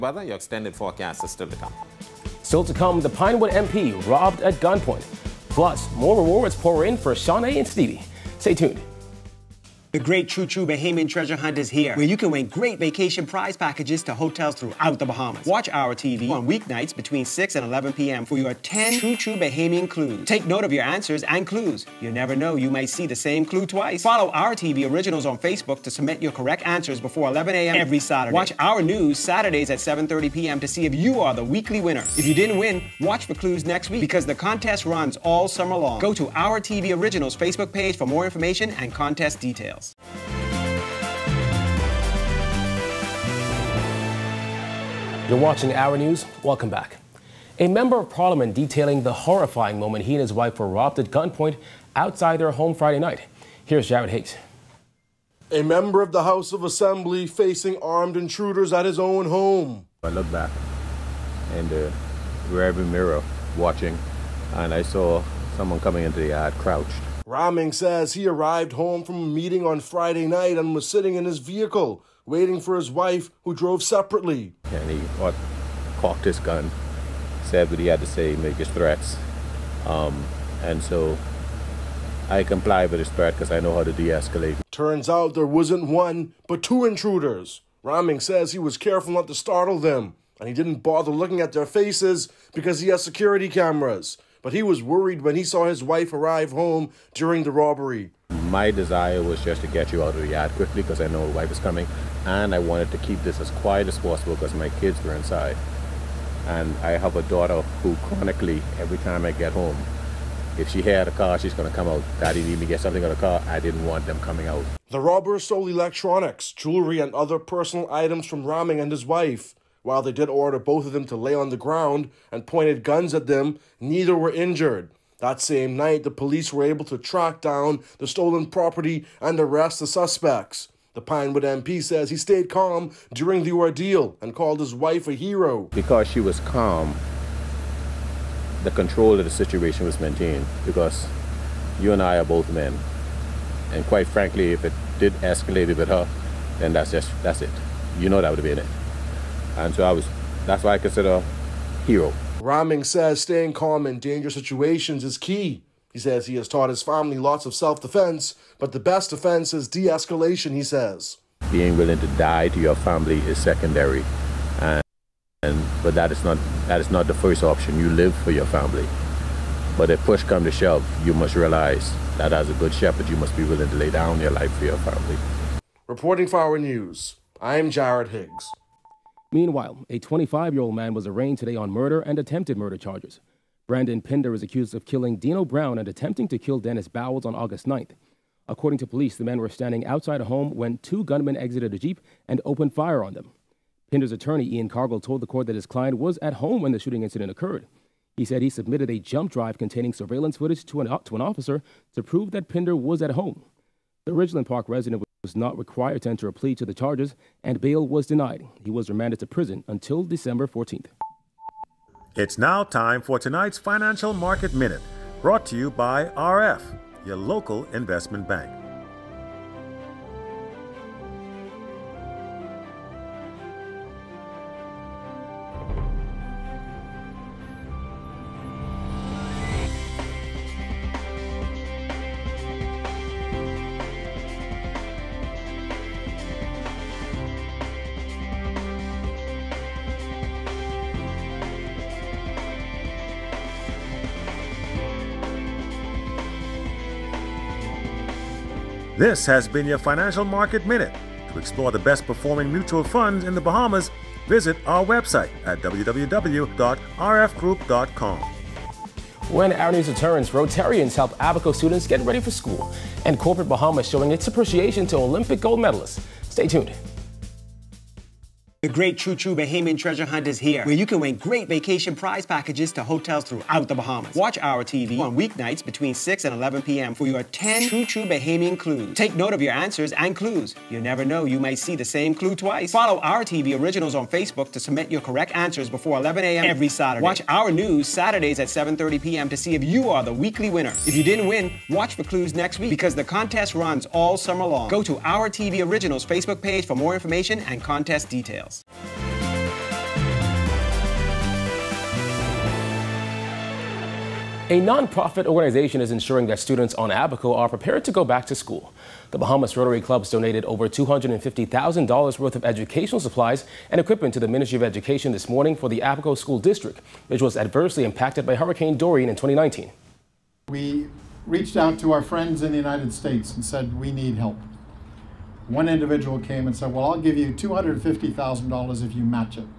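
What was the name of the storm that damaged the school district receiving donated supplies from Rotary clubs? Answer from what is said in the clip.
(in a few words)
Hurricane Dorian.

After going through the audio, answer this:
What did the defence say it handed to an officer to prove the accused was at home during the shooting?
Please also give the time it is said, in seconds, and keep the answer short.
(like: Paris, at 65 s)
jump drive, at 198 s.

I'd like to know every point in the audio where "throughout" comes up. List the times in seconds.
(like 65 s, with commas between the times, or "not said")
14 s, 273 s.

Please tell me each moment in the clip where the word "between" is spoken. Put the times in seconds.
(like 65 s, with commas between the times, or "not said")
16 s, 275 s.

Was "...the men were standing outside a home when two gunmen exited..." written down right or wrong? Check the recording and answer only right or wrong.
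right.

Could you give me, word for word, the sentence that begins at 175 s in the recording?
Reporting for our news, I'm Jared Higgs.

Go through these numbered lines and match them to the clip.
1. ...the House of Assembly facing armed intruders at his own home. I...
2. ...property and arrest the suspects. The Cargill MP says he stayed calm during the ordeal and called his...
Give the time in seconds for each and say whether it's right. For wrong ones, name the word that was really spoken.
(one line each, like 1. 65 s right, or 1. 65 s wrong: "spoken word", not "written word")
1. 56 s right
2. 128 s wrong: "Pinewood", not "Cargill".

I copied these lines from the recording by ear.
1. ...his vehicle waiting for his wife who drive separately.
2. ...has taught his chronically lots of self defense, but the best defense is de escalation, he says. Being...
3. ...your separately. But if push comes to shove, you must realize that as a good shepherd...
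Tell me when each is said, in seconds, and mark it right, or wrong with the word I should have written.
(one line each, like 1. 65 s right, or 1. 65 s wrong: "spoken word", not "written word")
1. 71 s wrong: "drove", not "drive"
2. 156 s wrong: "family", not "chronically"
3. 168 s wrong: "family", not "separately".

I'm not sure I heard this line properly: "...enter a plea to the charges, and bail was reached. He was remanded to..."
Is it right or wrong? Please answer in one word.
wrong.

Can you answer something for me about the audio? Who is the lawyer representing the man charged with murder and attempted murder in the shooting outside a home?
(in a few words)
Ian Cargill.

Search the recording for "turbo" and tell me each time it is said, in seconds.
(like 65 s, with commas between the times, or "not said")
not said.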